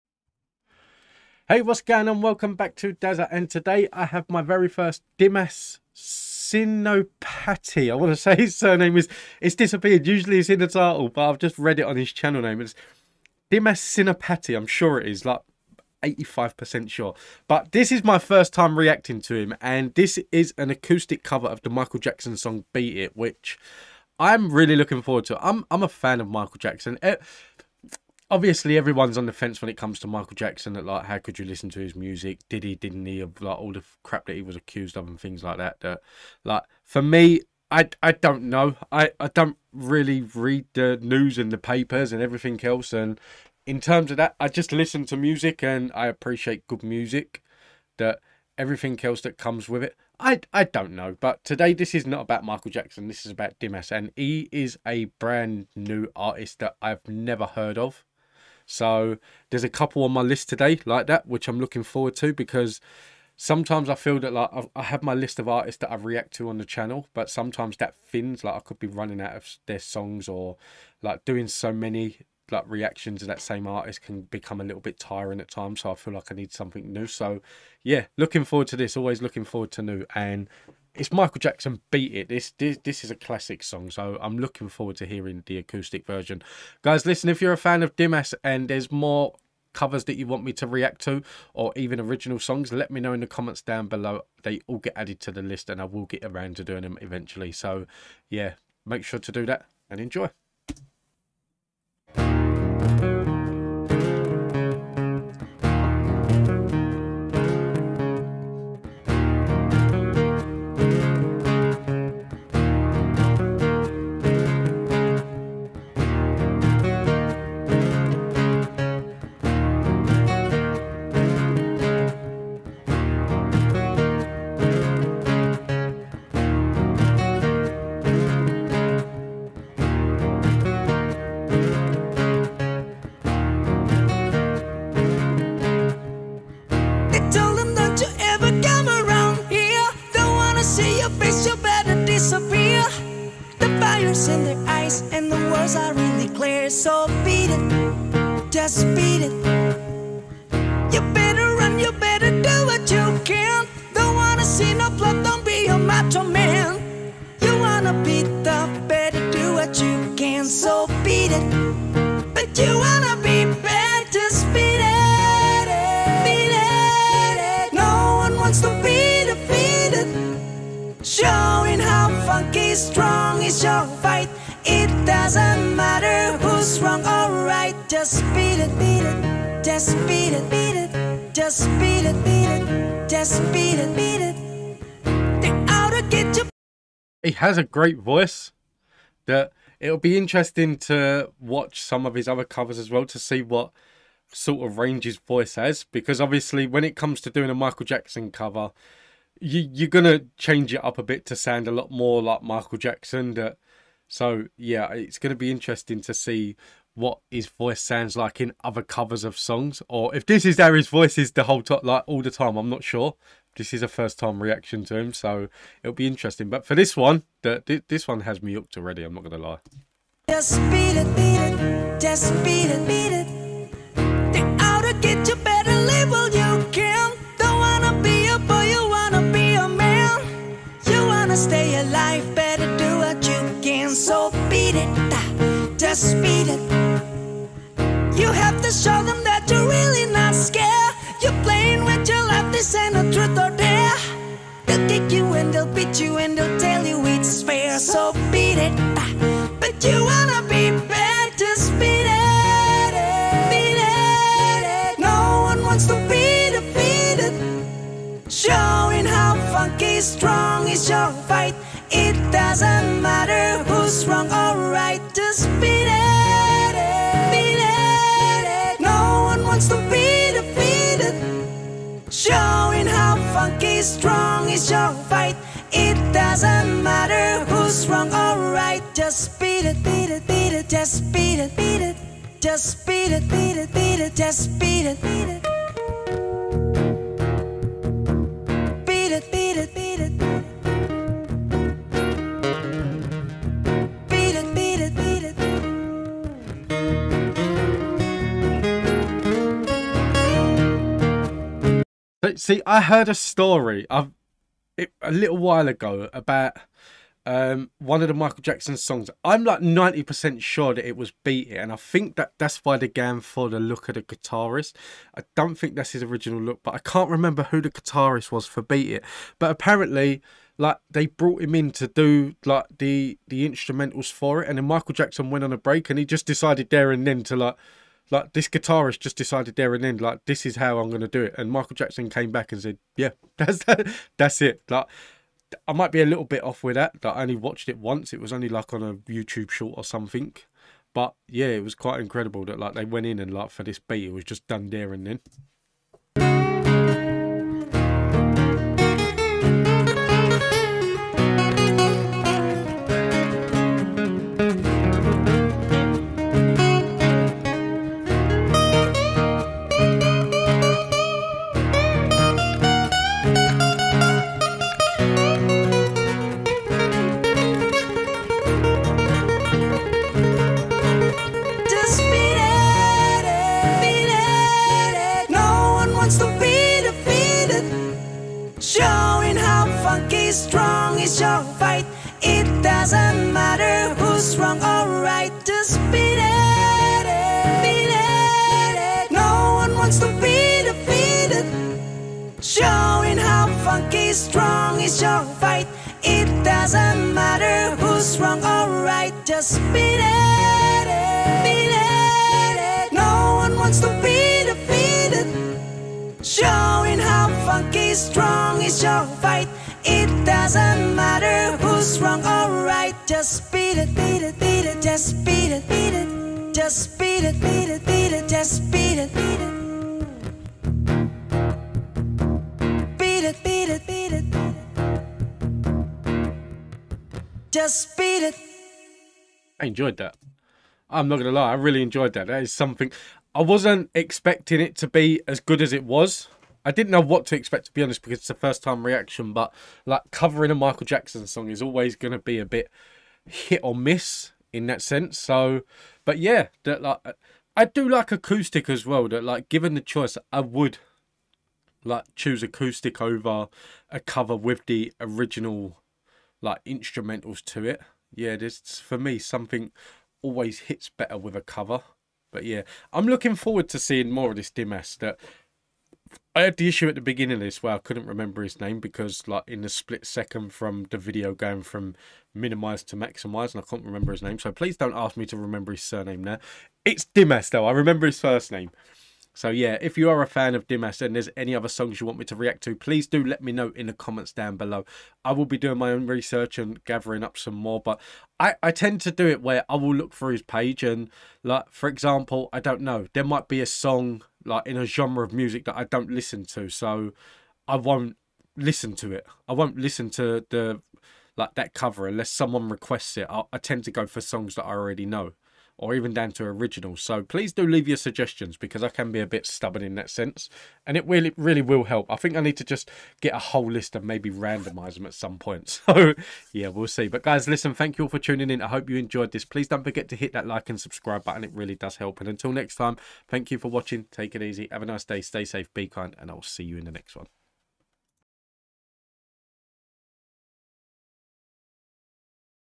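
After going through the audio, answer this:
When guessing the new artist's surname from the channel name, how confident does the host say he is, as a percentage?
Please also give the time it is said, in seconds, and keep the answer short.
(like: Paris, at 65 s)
85%, at 16 s.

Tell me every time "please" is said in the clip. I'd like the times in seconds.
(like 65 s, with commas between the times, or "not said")
474 s, 482 s, 507 s, 519 s.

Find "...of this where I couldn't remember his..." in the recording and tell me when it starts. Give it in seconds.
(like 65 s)
467 s.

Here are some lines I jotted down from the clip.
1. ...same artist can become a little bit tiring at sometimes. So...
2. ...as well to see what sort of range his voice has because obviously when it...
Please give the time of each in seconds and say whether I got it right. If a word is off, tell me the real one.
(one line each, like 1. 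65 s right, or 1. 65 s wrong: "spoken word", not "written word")
1. 73 s wrong: "times", not "sometimes"
2. 192 s right.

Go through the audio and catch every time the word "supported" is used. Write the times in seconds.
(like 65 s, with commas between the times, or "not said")
not said.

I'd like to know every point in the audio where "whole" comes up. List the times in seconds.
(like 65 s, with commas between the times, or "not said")
211 s, 513 s.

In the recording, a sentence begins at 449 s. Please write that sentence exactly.
That like given the choice, I would like choose acoustic over a cover with the original like instrumentals to it.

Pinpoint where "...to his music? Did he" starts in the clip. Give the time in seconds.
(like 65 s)
31 s.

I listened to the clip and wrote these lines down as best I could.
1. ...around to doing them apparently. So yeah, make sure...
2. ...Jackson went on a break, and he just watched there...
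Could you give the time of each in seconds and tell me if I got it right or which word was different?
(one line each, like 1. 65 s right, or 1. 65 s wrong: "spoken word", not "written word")
1. 96 s wrong: "eventually", not "apparently"
2. 324 s wrong: "decided", not "watched".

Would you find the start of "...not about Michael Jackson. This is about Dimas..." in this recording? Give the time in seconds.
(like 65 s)
52 s.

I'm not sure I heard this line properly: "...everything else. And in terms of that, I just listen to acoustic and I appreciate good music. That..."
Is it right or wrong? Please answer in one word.
wrong.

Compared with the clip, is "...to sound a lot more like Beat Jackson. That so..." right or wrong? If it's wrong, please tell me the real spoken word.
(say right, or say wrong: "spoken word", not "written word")
wrong: "Michael", not "Beat".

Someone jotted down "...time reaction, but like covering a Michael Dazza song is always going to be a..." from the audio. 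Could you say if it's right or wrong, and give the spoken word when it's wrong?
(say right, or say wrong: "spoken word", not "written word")
wrong: "Jackson", not "Dazza".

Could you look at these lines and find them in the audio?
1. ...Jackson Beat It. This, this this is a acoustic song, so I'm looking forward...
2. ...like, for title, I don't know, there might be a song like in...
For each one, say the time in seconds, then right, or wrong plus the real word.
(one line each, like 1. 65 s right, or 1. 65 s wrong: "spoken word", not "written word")
1. 81 s wrong: "classic", not "acoustic"
2. 491 s wrong: "example", not "title".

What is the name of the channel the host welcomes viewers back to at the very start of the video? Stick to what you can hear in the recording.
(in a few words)
Dazza.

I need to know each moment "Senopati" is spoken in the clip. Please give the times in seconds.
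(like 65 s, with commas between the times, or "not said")
5 s, 13 s.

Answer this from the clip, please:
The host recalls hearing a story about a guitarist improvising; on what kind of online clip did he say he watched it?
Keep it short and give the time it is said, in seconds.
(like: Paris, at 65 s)
A YouTube short, at 339 s.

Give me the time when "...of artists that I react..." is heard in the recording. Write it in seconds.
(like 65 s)
65 s.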